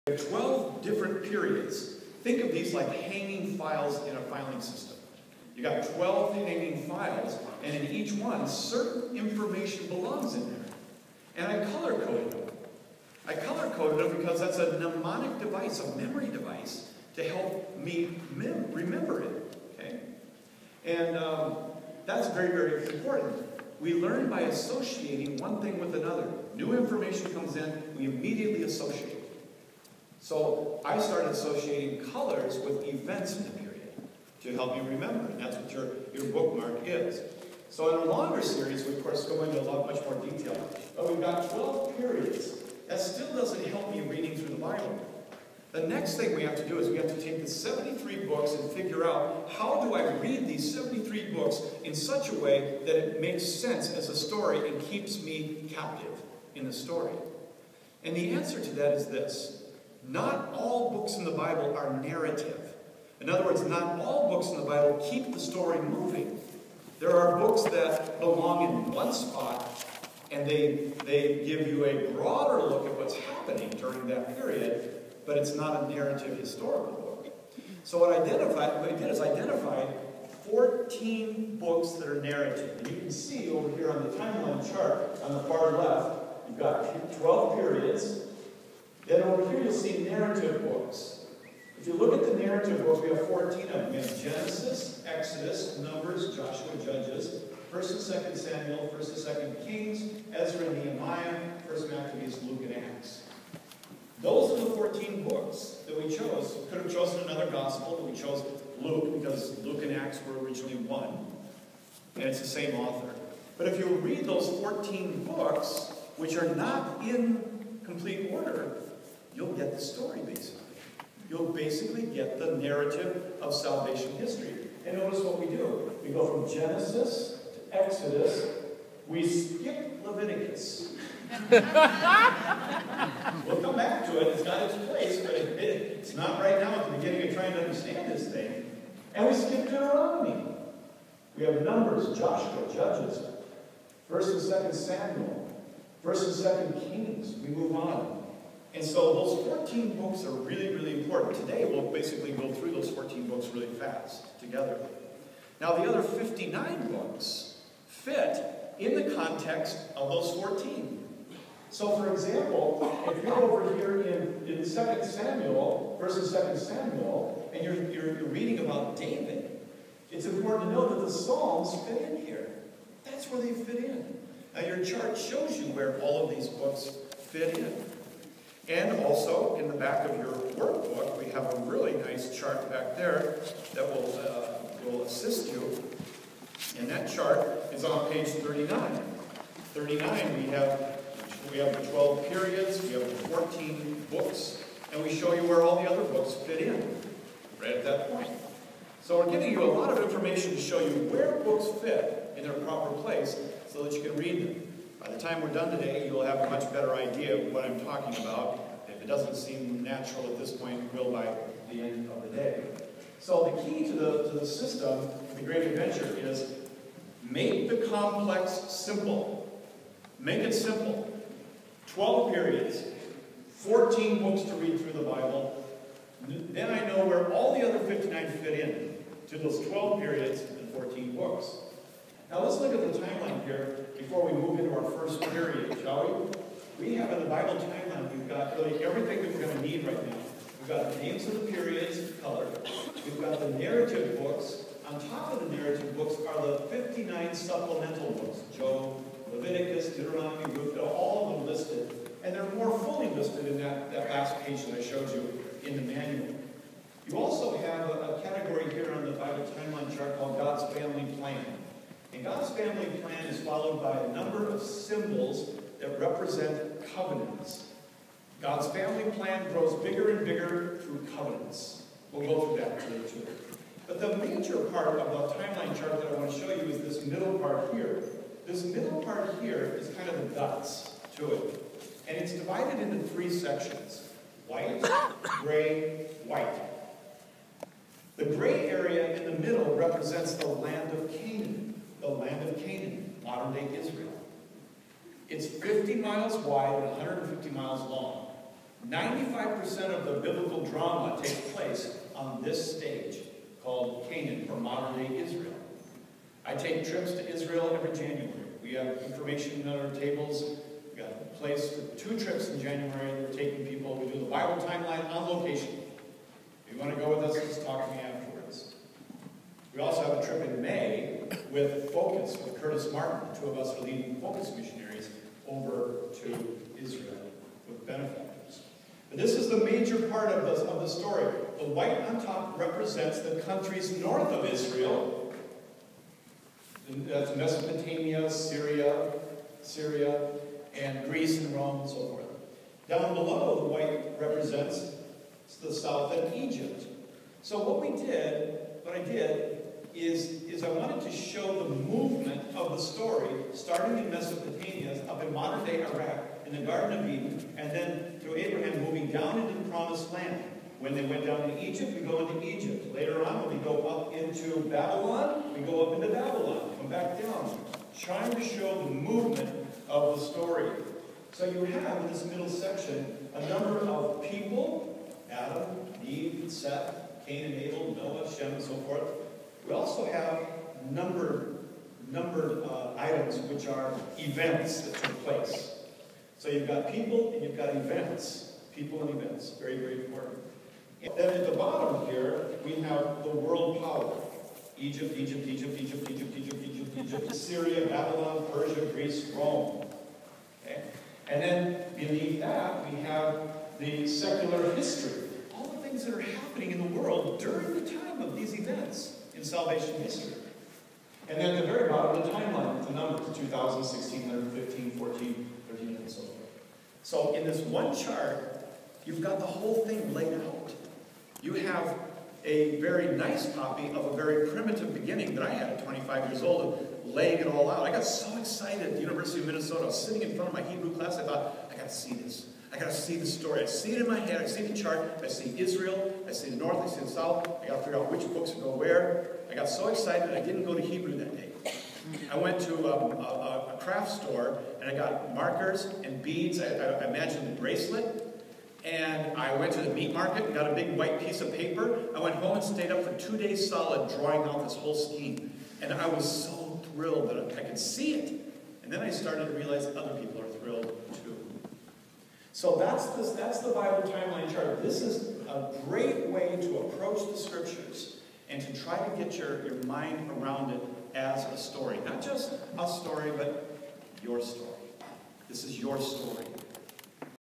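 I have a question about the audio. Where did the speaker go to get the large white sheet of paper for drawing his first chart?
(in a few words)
The meat market.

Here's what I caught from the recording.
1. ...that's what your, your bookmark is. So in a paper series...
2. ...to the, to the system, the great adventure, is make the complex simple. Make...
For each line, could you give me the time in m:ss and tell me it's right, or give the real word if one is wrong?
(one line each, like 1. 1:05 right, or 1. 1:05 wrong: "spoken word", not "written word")
1. 0:35 wrong: "longer", not "paper"
2. 3:33 right.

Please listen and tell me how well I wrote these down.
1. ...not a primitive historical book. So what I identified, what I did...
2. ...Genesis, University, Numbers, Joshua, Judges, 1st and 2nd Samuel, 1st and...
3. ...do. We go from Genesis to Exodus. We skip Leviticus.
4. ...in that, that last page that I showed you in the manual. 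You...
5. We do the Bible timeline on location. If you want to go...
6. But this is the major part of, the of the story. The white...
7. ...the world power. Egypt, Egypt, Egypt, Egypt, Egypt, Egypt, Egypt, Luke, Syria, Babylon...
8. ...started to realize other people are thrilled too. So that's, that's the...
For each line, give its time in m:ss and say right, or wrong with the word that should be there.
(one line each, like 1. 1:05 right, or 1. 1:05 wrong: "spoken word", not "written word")
1. 1:15 wrong: "narrative", not "primitive"
2. 1:34 wrong: "Exodus", not "University"
3. 2:05 right
4. 4:13 right
5. 5:13 right
6. 5:29 right
7. 6:33 wrong: "Egypt", not "Luke"
8. 7:39 right.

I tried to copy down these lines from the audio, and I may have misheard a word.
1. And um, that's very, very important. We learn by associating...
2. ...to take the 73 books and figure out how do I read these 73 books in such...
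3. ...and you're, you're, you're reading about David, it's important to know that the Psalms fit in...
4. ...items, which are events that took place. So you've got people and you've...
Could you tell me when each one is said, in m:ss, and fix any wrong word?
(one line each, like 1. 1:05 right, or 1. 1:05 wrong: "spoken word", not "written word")
1. 0:20 right
2. 0:47 right
3. 2:47 right
4. 6:22 right.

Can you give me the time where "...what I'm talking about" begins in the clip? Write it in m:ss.
3:27.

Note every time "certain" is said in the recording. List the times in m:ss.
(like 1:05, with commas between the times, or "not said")
0:08.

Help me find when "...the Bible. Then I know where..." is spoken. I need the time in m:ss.
3:44.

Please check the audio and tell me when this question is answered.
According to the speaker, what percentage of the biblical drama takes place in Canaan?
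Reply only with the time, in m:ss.
4:58.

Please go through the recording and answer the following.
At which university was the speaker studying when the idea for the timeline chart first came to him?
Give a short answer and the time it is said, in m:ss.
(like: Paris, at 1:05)
University of Minnesota, at 7:09.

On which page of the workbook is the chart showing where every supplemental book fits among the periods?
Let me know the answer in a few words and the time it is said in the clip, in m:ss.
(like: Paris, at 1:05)
39, at 3:06.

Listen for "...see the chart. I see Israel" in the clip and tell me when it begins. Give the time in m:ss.
7:14.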